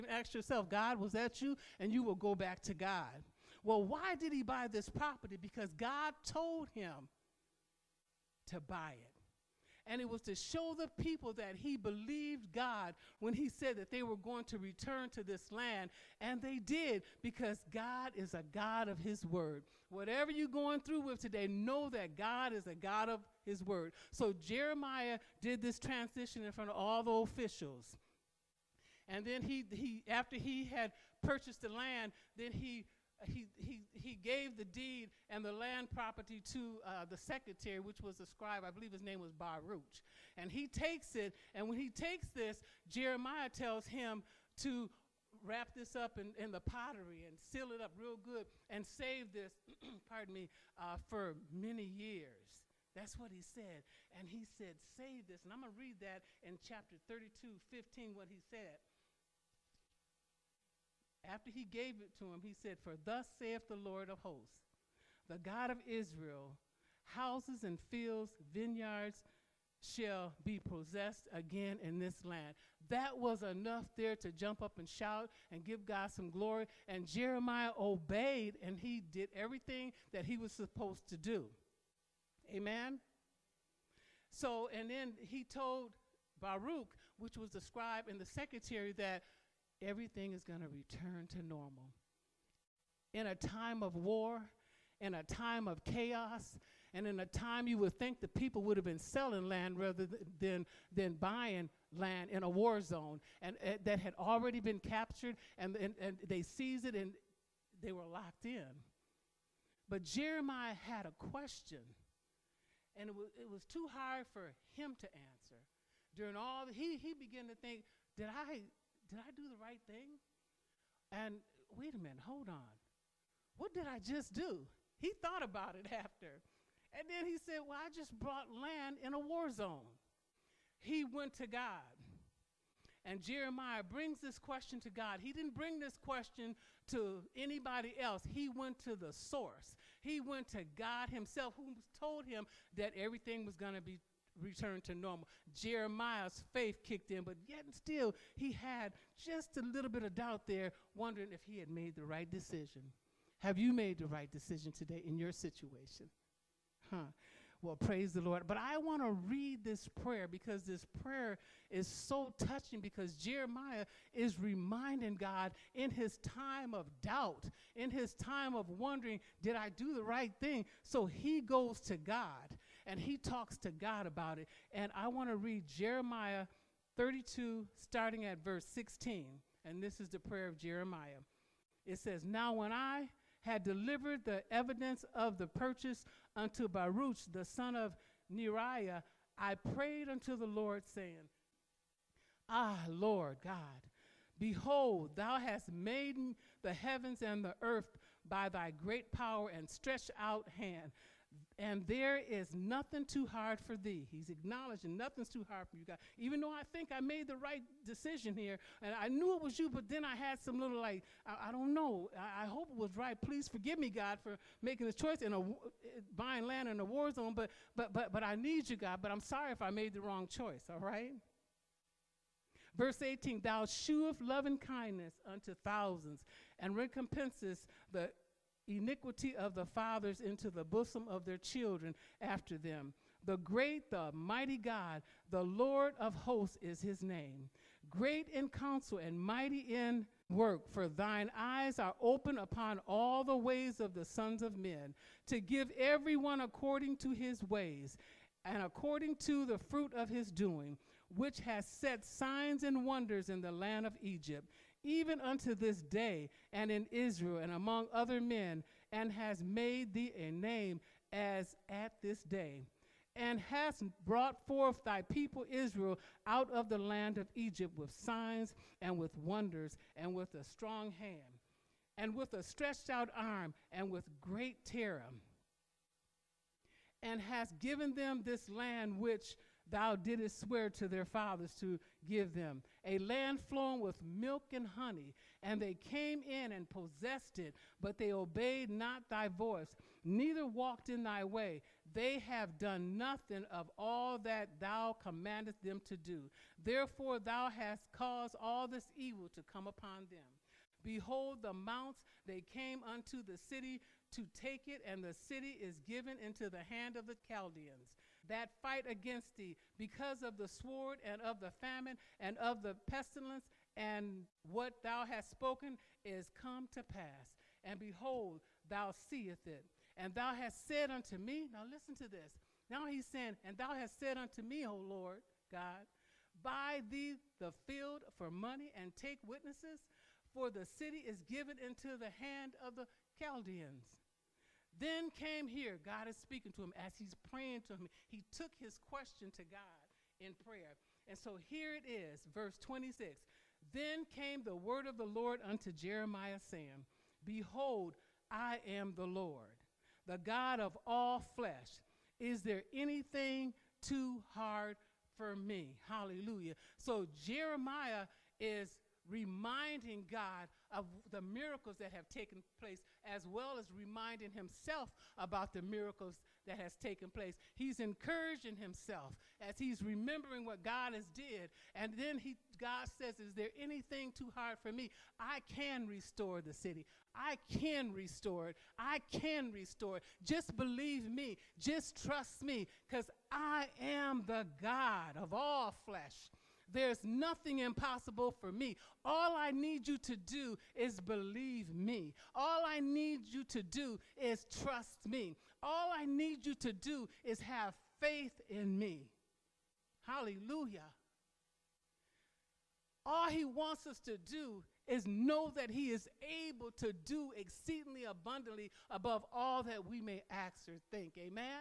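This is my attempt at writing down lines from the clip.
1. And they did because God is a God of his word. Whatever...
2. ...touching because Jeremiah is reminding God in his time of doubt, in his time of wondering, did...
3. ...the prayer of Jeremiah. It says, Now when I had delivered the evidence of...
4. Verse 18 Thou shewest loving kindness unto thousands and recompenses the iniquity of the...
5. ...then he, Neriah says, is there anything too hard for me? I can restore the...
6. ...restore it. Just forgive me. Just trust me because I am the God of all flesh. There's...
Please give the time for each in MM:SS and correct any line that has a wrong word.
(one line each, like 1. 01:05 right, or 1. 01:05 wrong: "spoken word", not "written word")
1. 00:16 right
2. 02:42 right
3. 03:00 right
4. 03:42 right
5. 06:11 wrong: "God", not "Neriah"
6. 06:19 wrong: "believe", not "forgive".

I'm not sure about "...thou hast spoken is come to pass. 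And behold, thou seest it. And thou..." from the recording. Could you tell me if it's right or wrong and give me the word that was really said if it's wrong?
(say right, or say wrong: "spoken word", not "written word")
right.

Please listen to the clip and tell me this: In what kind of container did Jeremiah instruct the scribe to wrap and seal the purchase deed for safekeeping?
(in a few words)
pottery.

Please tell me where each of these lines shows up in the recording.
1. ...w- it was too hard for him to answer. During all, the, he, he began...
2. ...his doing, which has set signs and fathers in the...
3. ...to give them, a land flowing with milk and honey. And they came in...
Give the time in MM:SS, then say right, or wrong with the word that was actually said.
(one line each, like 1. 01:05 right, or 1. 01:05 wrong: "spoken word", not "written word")
1. 01:53 right
2. 04:10 wrong: "wonders", not "fathers"
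3. 04:41 right.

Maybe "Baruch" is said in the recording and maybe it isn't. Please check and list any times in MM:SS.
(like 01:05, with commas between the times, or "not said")
00:39, 01:26, 03:06.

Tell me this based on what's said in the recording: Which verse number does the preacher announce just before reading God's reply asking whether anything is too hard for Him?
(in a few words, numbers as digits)
26.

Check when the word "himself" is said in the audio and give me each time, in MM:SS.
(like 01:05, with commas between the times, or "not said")
02:21, 06:04, 06:08.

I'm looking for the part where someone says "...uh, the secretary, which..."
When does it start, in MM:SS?
00:36.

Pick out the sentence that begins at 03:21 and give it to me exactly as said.
And there is nothing too hard for thee.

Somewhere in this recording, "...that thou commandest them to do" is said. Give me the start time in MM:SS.
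04:54.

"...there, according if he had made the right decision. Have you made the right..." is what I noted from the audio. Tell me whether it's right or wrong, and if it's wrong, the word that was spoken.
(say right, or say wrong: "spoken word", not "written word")
wrong: "wondering", not "according".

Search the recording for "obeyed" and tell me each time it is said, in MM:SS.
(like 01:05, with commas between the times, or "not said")
01:17, 04:48.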